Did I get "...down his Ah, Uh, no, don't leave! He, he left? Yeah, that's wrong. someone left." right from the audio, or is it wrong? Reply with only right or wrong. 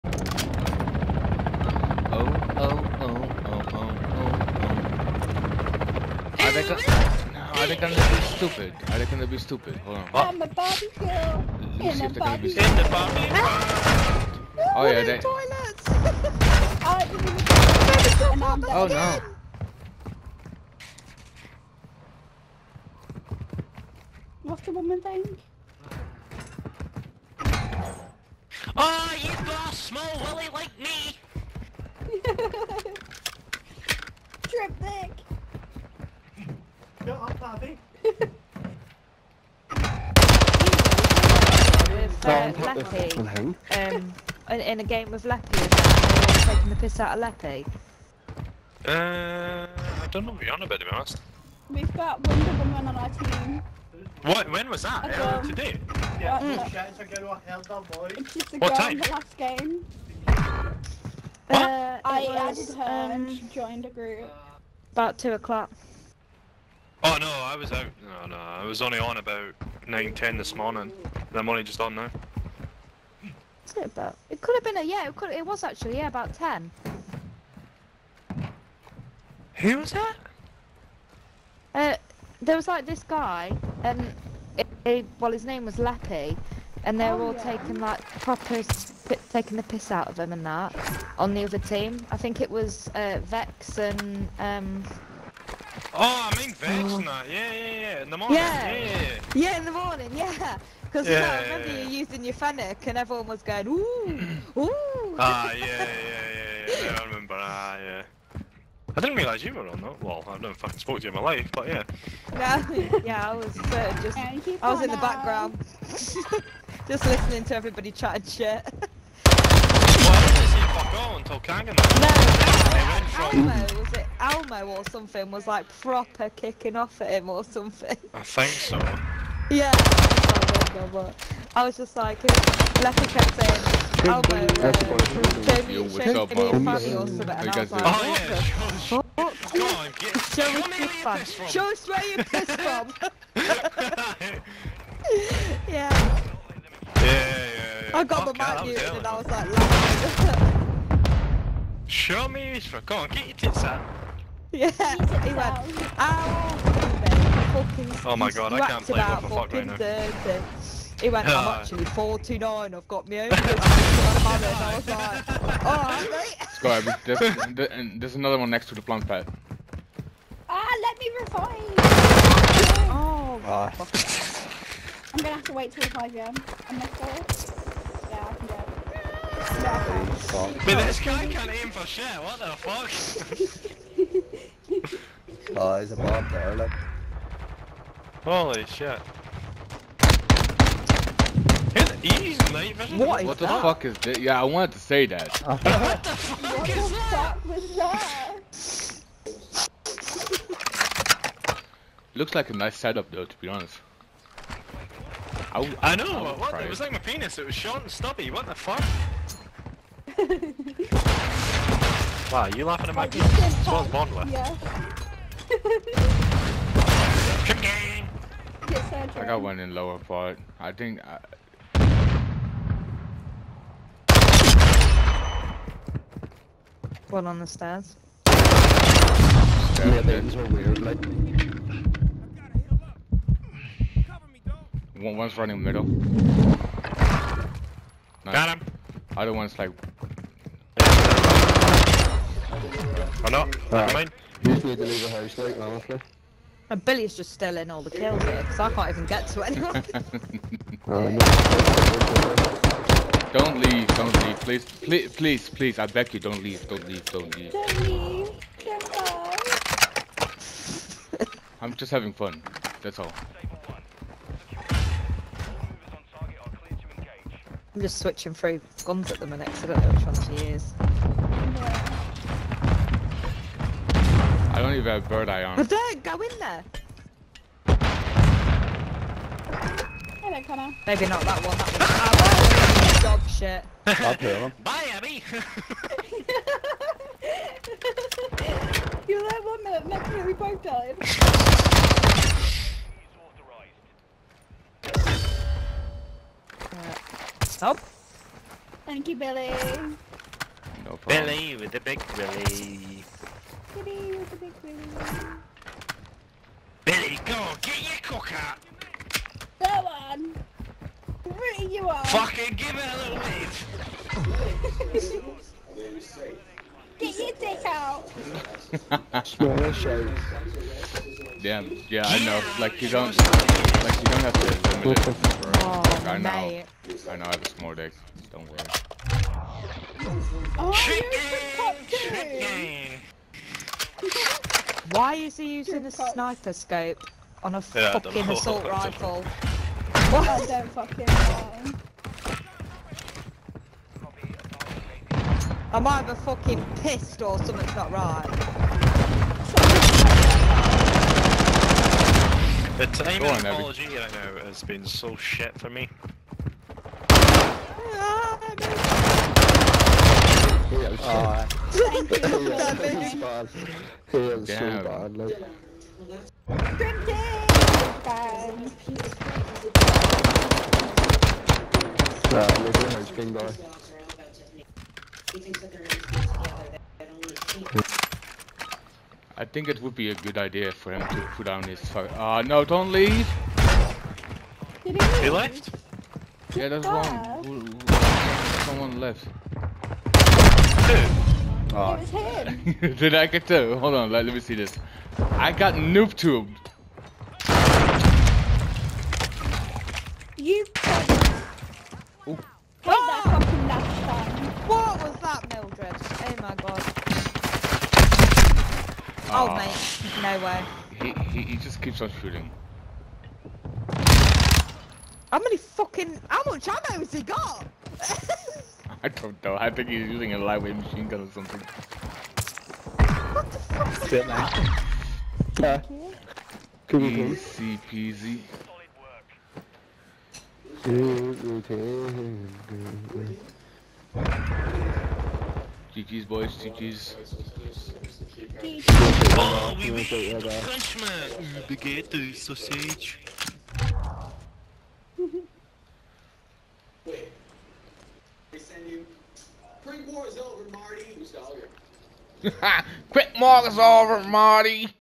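right.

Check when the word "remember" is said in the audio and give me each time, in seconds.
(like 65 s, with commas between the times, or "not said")
101 s, 107 s.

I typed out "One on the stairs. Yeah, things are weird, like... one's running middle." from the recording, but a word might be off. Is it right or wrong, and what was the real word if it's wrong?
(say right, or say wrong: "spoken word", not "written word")
right.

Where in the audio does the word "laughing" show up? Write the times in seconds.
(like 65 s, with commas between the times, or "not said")
149 s, 212 s.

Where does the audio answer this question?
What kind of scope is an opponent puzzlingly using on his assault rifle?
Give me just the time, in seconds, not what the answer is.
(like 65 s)
335 s.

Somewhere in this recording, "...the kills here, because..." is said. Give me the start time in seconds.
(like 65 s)
247 s.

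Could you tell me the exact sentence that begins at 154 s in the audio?
Yeah, he went, ow, fucking Oh my god, I can't play what the fuck right now.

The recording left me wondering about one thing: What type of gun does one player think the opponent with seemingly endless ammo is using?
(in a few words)
Lightweight machine gun.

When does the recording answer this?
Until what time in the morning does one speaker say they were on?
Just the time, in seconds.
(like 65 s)
69 s.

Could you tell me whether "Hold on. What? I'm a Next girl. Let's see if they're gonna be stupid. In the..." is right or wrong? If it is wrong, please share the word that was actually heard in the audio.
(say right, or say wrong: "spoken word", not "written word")
wrong: "Barbie", not "Next".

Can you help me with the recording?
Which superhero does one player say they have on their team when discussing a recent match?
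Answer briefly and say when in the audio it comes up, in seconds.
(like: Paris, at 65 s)
Wonder Woman, at 52 s.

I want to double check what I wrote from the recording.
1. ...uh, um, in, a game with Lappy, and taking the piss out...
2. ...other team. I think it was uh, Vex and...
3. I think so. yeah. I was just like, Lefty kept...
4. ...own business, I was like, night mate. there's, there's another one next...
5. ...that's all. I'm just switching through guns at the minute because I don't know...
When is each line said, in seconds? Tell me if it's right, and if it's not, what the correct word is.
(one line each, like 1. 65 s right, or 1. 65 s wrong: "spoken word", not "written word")
1. 42 s right
2. 91 s right
3. 128 s right
4. 163 s wrong: "alright", not "night"
5. 262 s right.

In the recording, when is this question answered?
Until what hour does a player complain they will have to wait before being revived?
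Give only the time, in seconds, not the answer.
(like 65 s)
175 s.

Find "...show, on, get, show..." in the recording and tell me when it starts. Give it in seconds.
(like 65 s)
139 s.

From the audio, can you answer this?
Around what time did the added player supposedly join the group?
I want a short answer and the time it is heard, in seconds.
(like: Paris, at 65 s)
2 o'clock, at 65 s.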